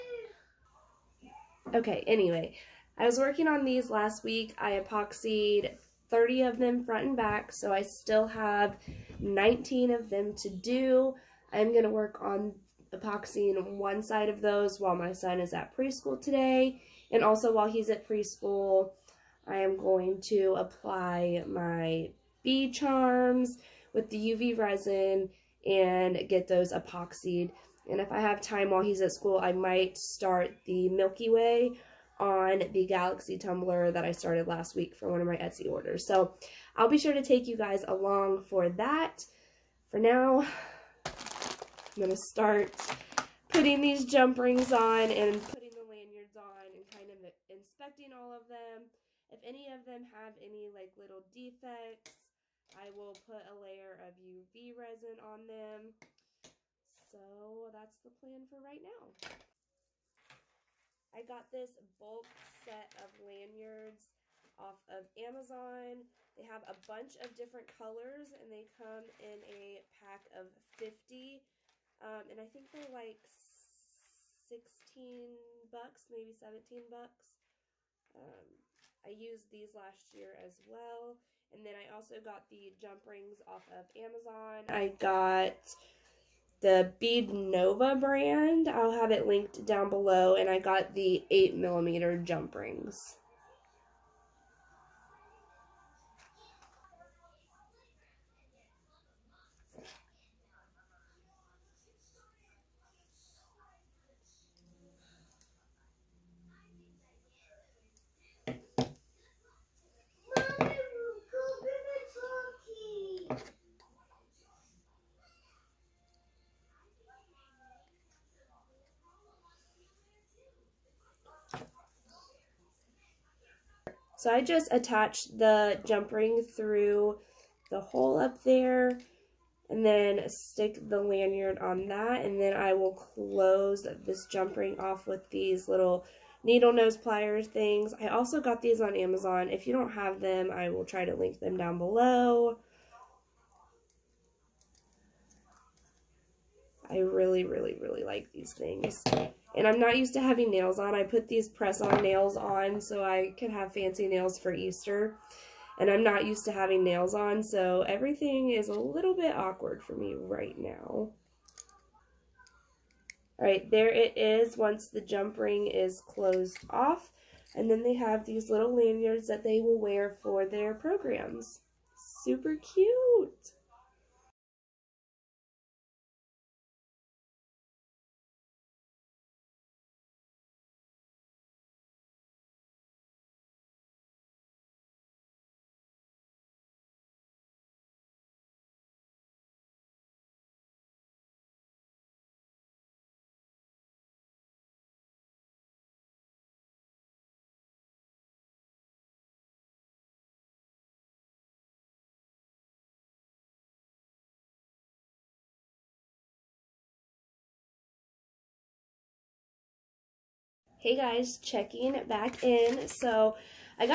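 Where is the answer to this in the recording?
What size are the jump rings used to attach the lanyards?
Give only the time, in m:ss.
1:31.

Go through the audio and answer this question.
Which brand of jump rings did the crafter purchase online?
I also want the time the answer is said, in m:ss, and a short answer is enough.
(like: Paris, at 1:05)
Bead Nova, at 1:26.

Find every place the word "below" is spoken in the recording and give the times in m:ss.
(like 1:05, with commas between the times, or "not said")
1:29, 2:21.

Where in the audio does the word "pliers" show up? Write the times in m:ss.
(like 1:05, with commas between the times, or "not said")
2:16.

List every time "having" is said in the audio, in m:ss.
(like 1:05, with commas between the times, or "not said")
2:30, 2:36.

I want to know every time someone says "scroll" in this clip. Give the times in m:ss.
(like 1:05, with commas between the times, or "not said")
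not said.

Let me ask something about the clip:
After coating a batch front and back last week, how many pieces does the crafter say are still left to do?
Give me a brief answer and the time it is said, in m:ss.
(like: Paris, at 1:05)
19, at 0:09.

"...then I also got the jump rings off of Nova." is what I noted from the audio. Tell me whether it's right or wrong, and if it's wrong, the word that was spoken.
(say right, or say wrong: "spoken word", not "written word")
wrong: "Amazon", not "Nova".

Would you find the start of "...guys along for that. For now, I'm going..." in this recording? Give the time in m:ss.
0:37.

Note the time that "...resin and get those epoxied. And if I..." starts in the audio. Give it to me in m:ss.
0:24.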